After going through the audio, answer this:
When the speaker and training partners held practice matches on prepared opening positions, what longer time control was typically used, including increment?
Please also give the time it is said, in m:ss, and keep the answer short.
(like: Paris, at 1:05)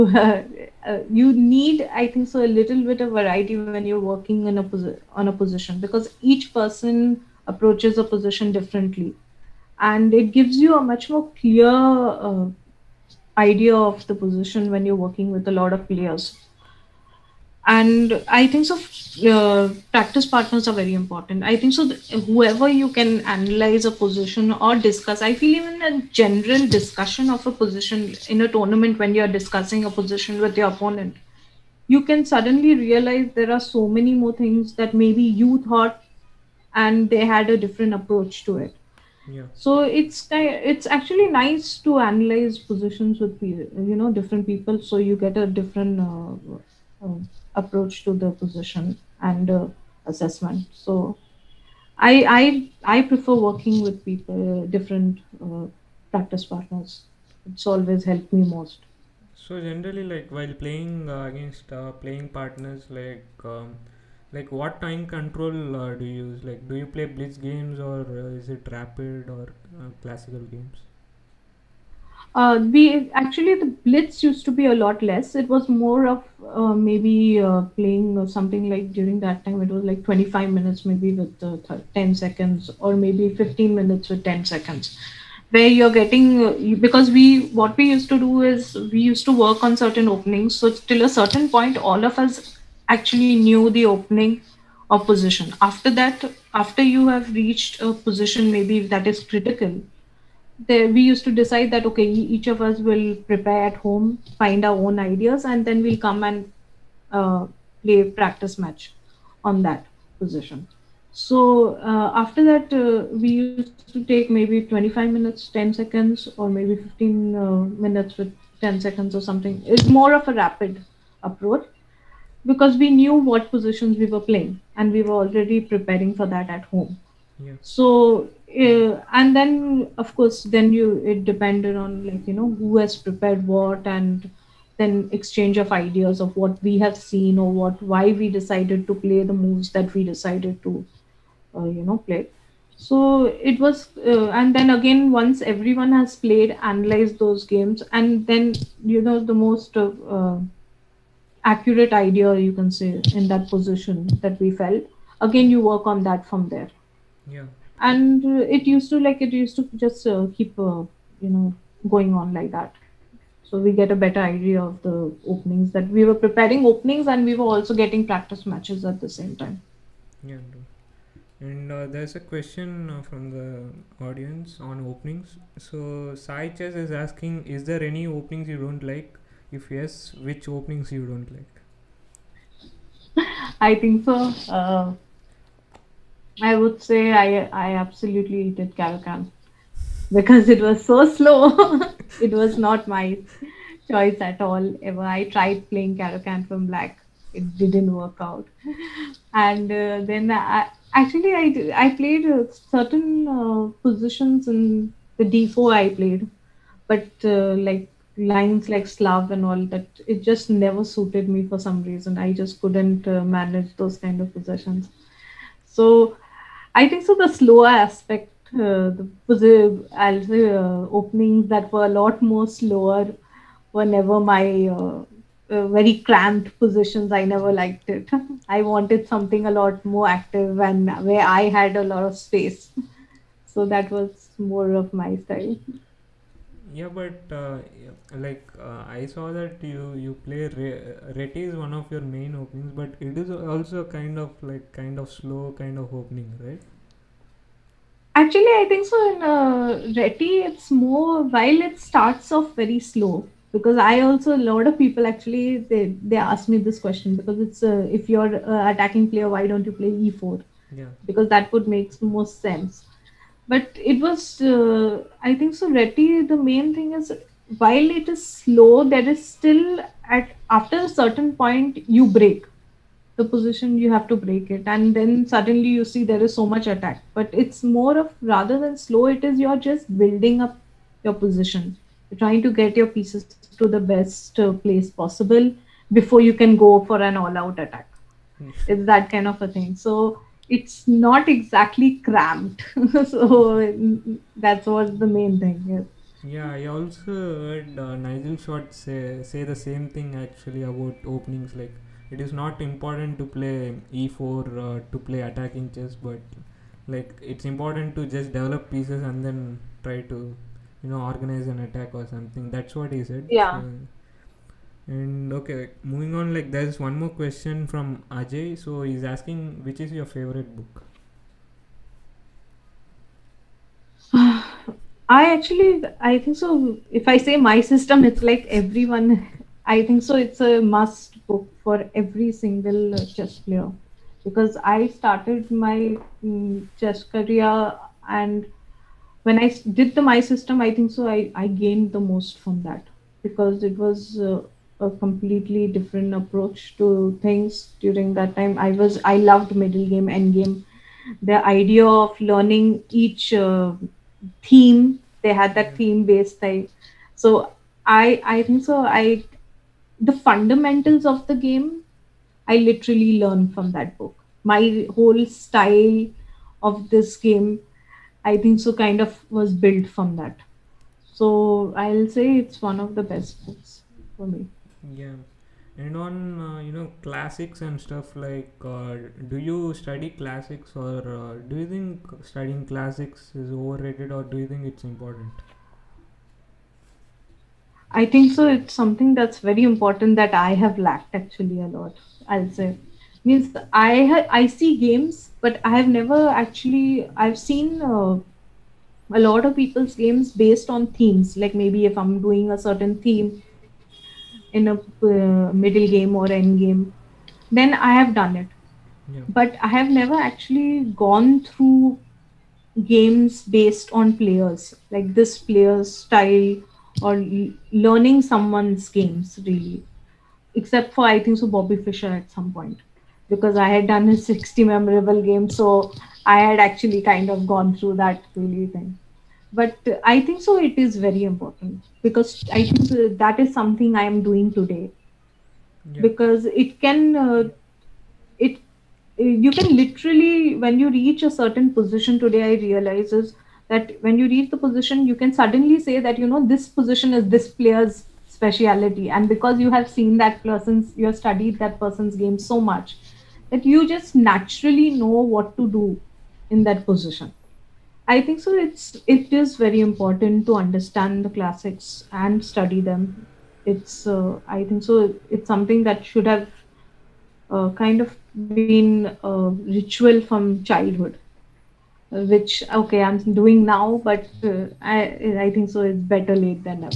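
25 minutes with 10 seconds, at 1:20.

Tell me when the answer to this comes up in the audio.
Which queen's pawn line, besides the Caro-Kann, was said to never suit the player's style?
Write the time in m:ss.
3:28.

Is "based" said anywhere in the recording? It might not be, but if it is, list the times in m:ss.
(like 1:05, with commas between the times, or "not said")
5:56, 6:40, 6:53.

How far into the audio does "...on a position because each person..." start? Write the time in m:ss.
0:05.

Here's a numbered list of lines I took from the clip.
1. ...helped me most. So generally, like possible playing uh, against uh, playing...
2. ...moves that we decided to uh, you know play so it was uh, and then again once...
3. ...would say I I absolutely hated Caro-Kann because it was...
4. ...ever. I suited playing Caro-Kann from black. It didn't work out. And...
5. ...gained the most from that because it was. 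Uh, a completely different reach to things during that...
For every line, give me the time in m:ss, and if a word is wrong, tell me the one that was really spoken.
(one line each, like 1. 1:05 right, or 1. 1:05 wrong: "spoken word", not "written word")
1. 0:58 wrong: "while", not "possible"
2. 2:19 right
3. 3:06 right
4. 3:14 wrong: "tried", not "suited"
5. 5:41 wrong: "approach", not "reach".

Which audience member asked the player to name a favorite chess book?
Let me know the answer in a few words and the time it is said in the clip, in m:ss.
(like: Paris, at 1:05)
Ajay, at 5:18.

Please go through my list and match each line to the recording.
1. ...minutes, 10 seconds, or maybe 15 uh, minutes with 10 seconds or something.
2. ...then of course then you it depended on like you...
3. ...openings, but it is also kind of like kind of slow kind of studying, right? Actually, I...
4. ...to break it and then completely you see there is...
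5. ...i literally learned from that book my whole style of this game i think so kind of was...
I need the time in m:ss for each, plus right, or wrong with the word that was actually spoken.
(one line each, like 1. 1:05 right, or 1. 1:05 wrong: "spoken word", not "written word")
1. 1:55 right
2. 2:09 right
3. 4:02 wrong: "opening", not "studying"
4. 4:34 wrong: "suddenly", not "completely"
5. 6:02 right.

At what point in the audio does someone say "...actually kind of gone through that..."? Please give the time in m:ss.
7:06.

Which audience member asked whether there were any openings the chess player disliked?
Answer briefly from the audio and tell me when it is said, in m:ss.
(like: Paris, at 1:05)
Sai Chess, at 2:56.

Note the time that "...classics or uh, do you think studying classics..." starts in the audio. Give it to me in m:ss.
6:20.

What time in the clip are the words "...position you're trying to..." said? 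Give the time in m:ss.
4:41.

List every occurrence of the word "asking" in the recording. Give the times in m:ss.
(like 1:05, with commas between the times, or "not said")
2:56, 5:19.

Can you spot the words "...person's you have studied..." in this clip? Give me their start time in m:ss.
7:30.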